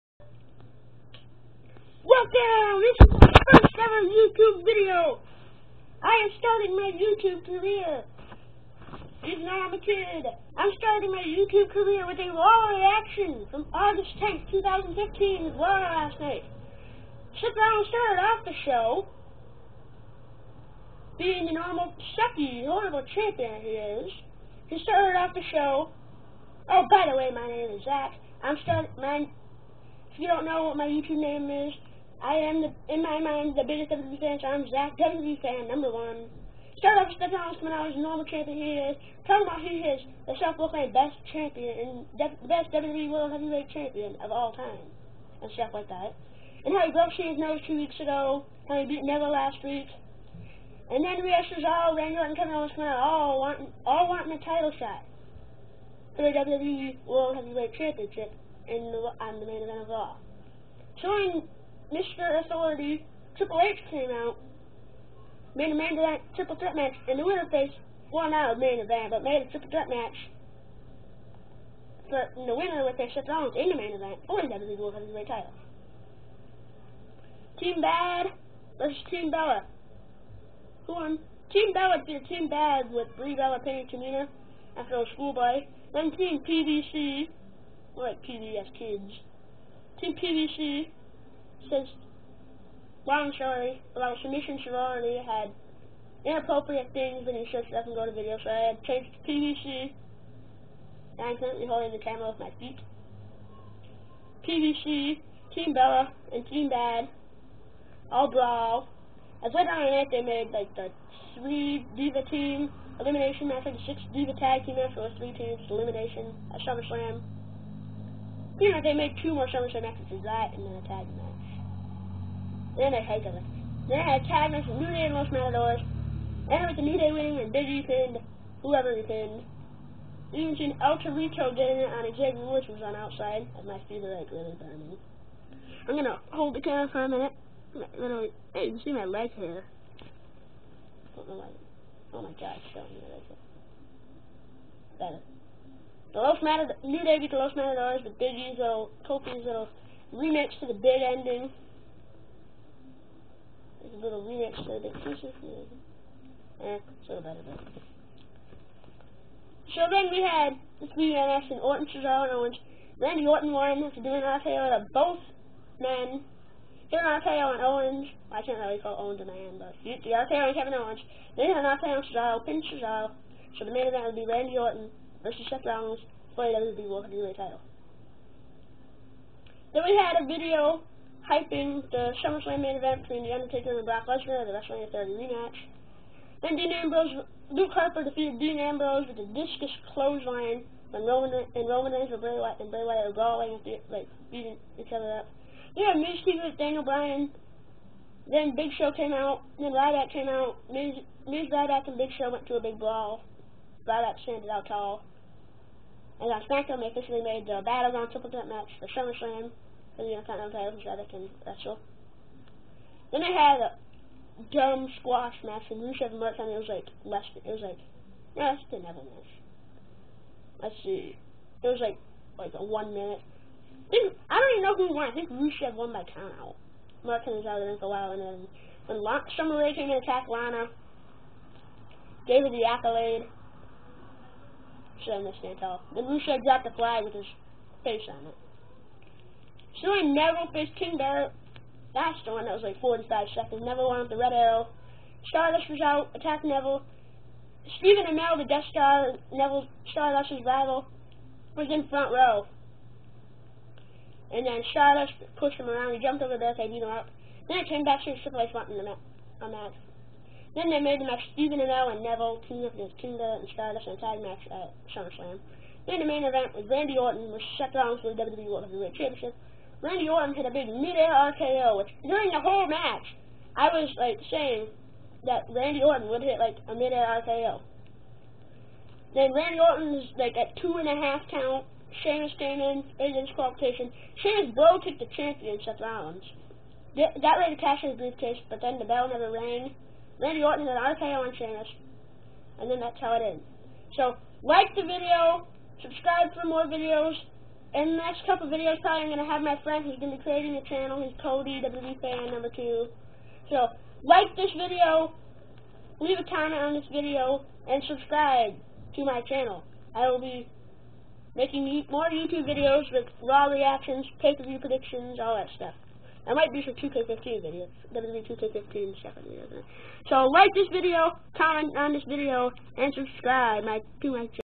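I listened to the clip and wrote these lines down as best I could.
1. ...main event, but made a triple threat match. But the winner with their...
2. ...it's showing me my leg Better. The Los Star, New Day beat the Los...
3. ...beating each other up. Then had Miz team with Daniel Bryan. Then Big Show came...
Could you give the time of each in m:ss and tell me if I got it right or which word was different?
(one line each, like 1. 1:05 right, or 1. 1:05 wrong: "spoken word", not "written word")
1. 1:08 right
2. 2:22 wrong: "Matadors", not "Star"
3. 3:14 right.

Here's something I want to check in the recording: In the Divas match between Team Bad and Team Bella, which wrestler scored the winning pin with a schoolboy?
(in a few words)
Brie Bella.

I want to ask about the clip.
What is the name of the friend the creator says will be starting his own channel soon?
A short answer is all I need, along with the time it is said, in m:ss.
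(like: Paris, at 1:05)
Cody, at 5:01.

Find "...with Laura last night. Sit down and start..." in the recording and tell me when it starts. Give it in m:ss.
0:15.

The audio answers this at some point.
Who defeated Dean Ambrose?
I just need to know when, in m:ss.
3:07.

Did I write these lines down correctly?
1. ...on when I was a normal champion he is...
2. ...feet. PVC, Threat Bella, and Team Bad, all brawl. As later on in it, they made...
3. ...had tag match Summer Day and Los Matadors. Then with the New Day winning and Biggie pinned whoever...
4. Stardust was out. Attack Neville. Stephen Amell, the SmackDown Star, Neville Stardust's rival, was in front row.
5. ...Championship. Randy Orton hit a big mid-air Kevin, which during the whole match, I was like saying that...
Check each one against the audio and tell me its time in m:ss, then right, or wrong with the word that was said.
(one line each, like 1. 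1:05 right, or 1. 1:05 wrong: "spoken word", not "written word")
1. 0:37 right
2. 1:42 wrong: "Team", not "Threat"
3. 2:04 wrong: "New", not "Summer"
4. 4:05 wrong: "Death", not "SmackDown"
5. 4:28 wrong: "RKO", not "Kevin".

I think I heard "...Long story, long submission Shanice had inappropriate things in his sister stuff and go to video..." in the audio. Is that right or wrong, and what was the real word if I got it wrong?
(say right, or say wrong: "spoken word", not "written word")
right.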